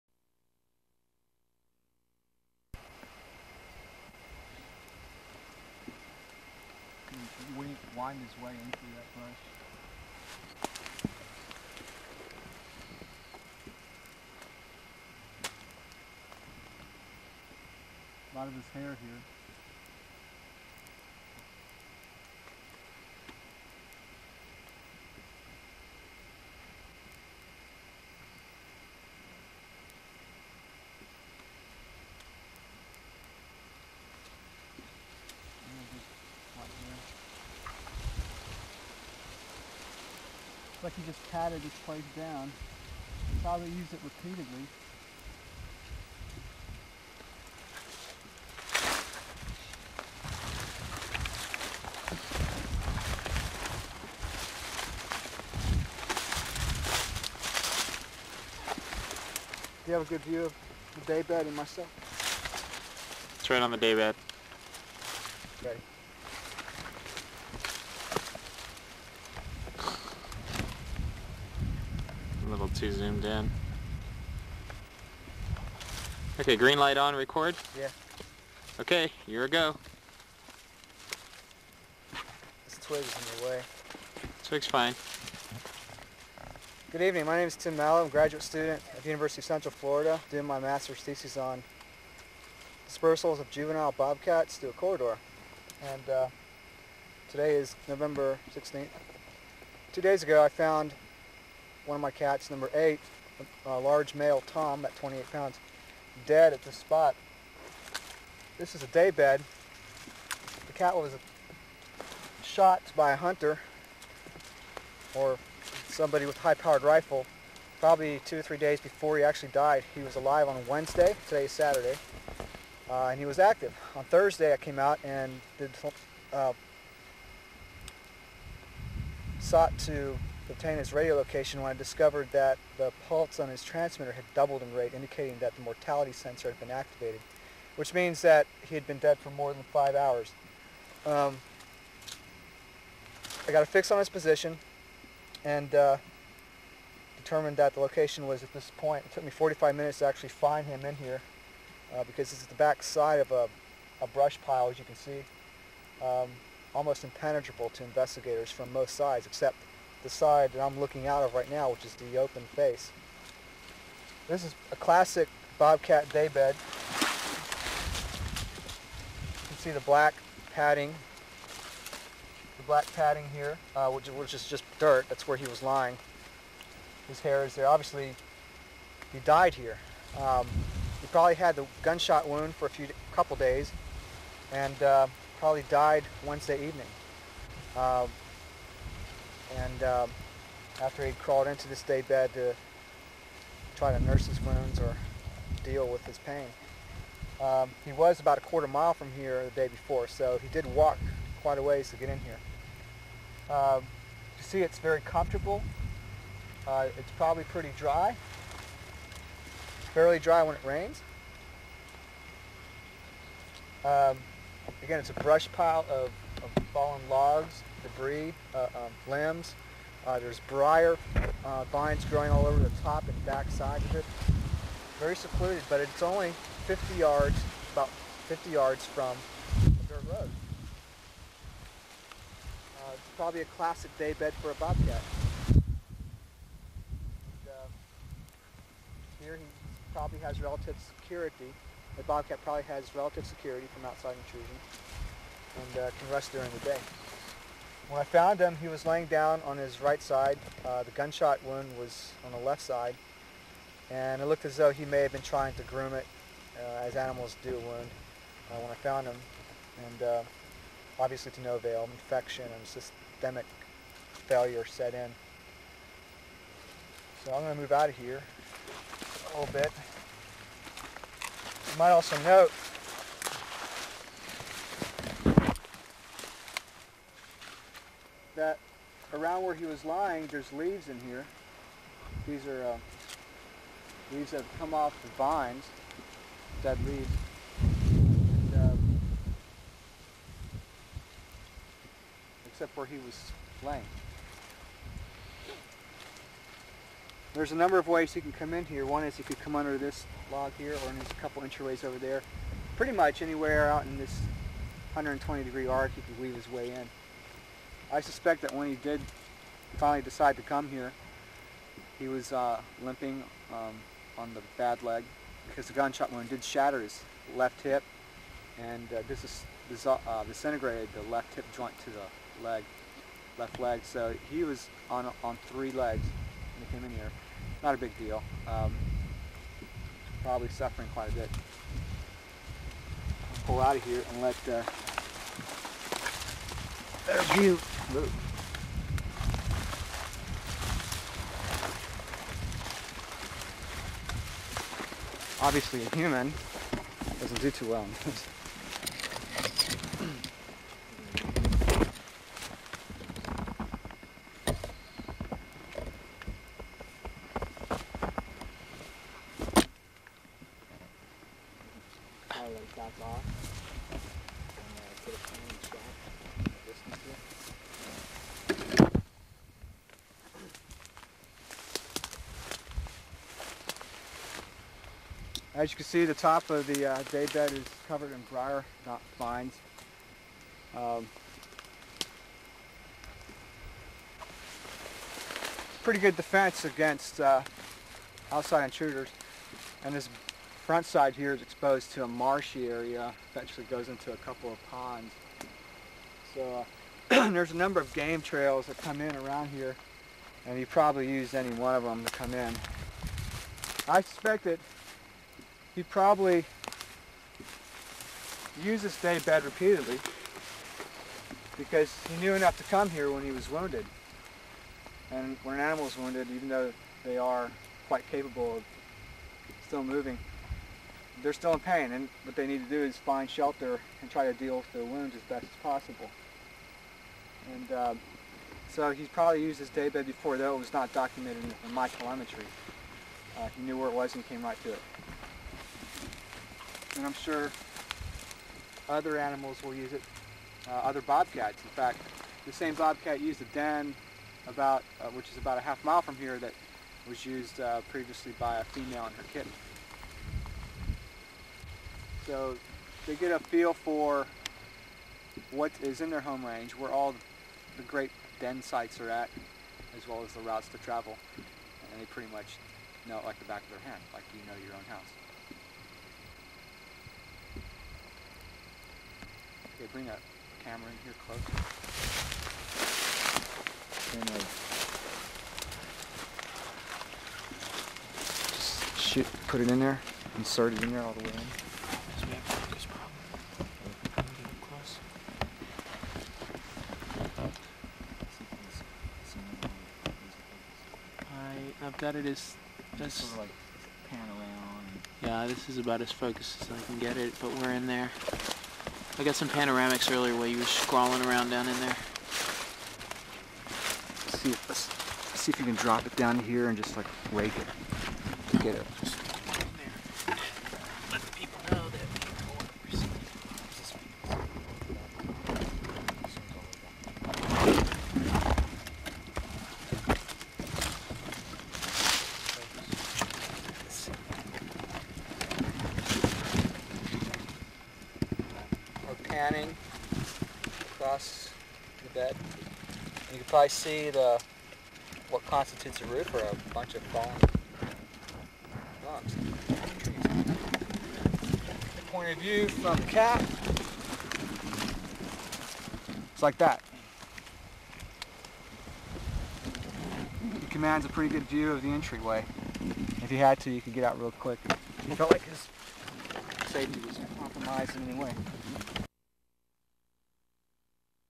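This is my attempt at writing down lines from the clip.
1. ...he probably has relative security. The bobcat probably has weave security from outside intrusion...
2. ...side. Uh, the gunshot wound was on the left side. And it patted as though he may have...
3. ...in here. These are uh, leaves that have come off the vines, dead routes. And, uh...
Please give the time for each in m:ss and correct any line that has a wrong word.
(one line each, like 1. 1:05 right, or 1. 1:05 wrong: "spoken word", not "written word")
1. 3:59 wrong: "relative", not "weave"
2. 4:10 wrong: "looked", not "patted"
3. 4:40 wrong: "leaves", not "routes".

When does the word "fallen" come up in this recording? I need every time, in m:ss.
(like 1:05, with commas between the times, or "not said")
3:36, 8:57.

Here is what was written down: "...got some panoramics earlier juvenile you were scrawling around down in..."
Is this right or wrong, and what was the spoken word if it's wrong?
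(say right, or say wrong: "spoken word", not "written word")
wrong: "while", not "juvenile".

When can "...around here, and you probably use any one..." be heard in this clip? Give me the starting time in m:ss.
6:39.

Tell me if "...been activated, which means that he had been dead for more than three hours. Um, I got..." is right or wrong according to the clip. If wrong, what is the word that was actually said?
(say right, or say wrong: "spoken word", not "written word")
wrong: "five", not "three".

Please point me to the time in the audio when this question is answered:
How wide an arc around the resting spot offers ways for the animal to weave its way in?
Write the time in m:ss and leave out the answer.
5:04.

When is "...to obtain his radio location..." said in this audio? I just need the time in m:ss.
2:09.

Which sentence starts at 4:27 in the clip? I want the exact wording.
So I'm going to move out of here a little bit.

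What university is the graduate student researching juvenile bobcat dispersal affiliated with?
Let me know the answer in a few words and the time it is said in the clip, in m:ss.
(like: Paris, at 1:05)
University of Central Florida, at 1:29.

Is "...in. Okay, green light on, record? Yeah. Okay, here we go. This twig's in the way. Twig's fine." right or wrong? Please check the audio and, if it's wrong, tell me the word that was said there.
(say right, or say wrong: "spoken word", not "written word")
right.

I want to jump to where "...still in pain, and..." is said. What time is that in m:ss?
7:01.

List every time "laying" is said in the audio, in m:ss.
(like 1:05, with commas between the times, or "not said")
4:08, 4:53.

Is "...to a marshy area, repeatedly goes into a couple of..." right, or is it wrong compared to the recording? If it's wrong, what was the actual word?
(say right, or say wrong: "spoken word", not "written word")
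wrong: "eventually", not "repeatedly".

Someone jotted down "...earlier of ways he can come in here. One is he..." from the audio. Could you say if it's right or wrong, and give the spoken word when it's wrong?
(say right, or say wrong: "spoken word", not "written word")
wrong: "number", not "earlier".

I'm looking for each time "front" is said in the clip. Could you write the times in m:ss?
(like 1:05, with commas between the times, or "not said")
6:30.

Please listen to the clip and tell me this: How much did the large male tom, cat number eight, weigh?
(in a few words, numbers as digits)
28 pounds.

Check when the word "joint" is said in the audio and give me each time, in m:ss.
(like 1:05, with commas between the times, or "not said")
5:21.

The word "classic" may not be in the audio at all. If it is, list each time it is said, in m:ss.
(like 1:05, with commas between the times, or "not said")
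2:44, 3:53.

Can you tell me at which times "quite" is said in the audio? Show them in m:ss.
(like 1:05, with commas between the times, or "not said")
3:21, 5:30, 6:57.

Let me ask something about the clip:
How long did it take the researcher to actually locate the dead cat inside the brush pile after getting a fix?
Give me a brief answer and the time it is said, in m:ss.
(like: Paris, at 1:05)
45 minutes, at 2:29.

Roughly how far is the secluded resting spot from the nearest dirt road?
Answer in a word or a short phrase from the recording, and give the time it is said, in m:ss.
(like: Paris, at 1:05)
50 yards, at 3:47.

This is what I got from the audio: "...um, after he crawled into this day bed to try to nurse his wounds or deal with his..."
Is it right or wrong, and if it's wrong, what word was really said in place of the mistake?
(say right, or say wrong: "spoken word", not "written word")
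right.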